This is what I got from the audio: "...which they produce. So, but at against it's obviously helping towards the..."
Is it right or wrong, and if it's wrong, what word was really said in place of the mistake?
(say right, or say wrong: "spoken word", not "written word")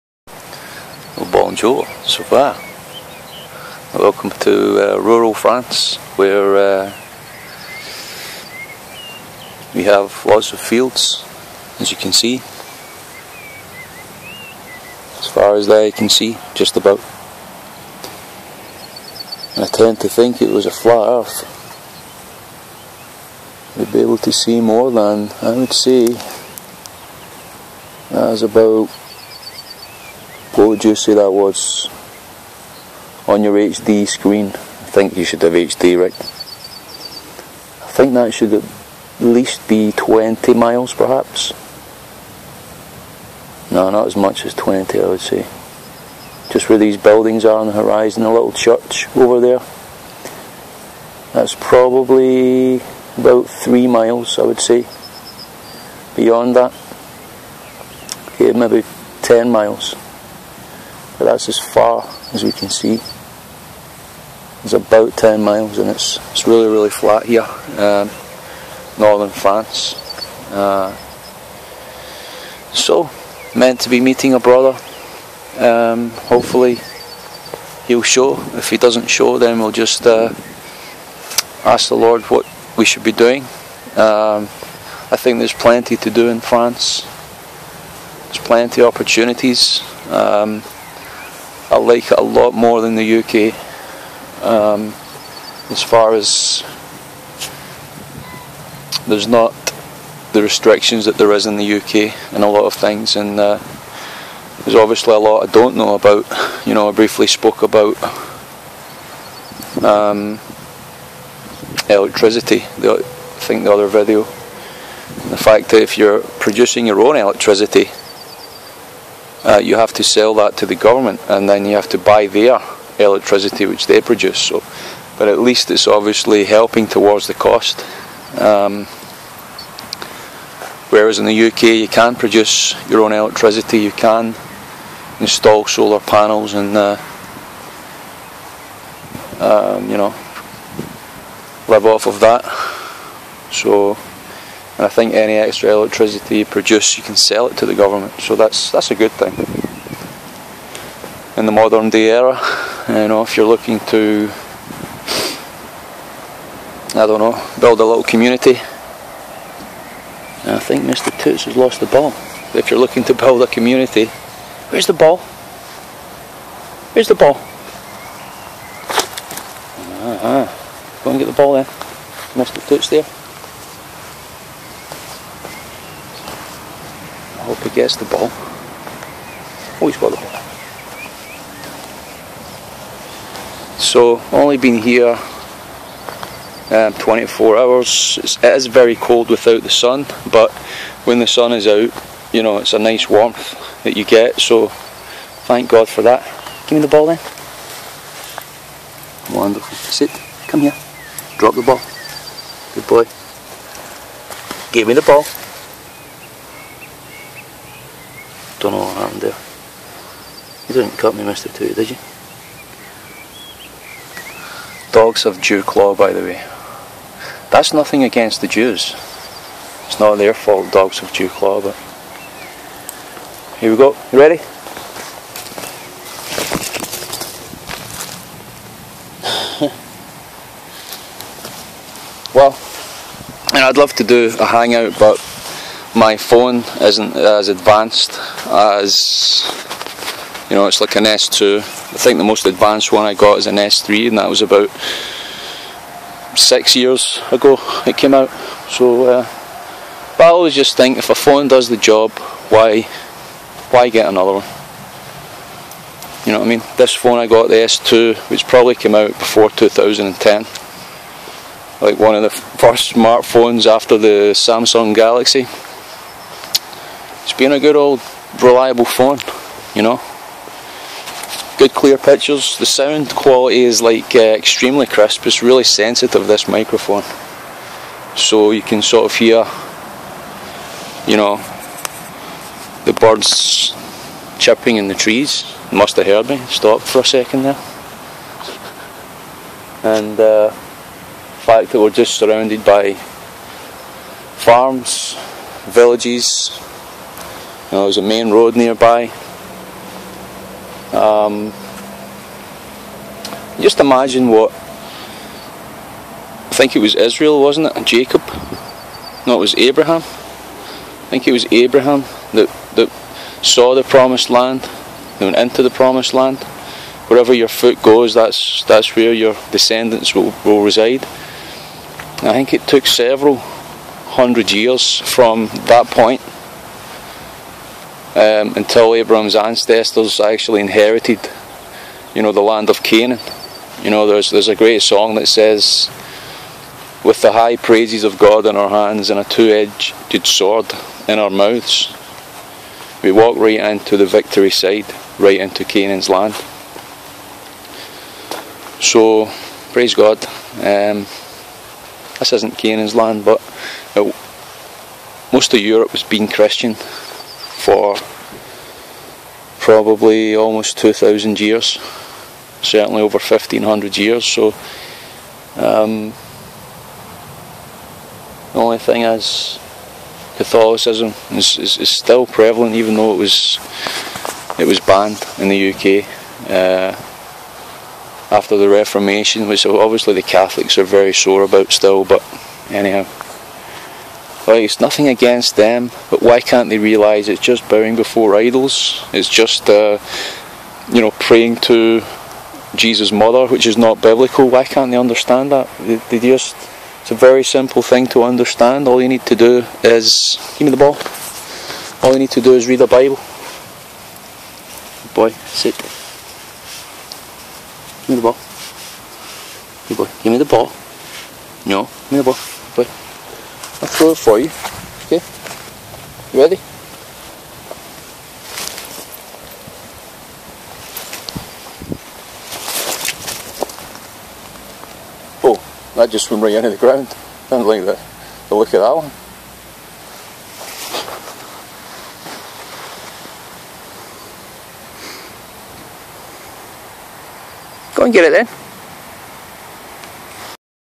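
wrong: "least", not "against".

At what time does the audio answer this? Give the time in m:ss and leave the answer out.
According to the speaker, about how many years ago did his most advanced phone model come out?
4:06.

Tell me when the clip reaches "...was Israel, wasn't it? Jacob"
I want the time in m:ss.
5:06.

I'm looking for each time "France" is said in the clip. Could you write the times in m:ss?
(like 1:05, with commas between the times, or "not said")
0:05, 1:09, 1:26.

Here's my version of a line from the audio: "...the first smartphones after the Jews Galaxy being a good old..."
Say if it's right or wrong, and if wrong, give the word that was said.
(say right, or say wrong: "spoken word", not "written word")
wrong: "Samsung", not "Jews".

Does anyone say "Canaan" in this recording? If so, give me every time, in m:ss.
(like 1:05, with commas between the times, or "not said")
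5:32, 5:45, 5:52.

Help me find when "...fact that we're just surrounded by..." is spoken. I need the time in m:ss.
4:51.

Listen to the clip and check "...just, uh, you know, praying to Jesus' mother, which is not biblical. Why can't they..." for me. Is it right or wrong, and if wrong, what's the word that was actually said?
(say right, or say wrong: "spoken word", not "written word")
right.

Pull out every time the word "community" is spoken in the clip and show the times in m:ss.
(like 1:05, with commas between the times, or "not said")
2:38, 2:43.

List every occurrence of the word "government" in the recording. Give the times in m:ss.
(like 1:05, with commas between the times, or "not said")
2:00, 2:27.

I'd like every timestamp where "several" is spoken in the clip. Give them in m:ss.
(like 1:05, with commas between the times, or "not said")
5:22.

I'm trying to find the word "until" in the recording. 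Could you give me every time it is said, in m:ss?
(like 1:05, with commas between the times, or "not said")
5:28.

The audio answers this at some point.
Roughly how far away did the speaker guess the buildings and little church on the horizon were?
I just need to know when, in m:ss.
0:53.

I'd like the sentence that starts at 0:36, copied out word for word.
I think that should at least be 20 miles, perhaps.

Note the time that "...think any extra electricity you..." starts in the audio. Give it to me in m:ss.
2:24.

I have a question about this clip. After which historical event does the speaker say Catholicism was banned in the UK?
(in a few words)
The Reformation.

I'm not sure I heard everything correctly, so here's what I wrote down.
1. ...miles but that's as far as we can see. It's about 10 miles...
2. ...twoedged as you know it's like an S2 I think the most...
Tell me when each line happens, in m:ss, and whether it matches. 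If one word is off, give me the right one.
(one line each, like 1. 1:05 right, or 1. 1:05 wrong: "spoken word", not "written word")
1. 0:59 right
2. 3:57 wrong: "advanced", not "twoedged".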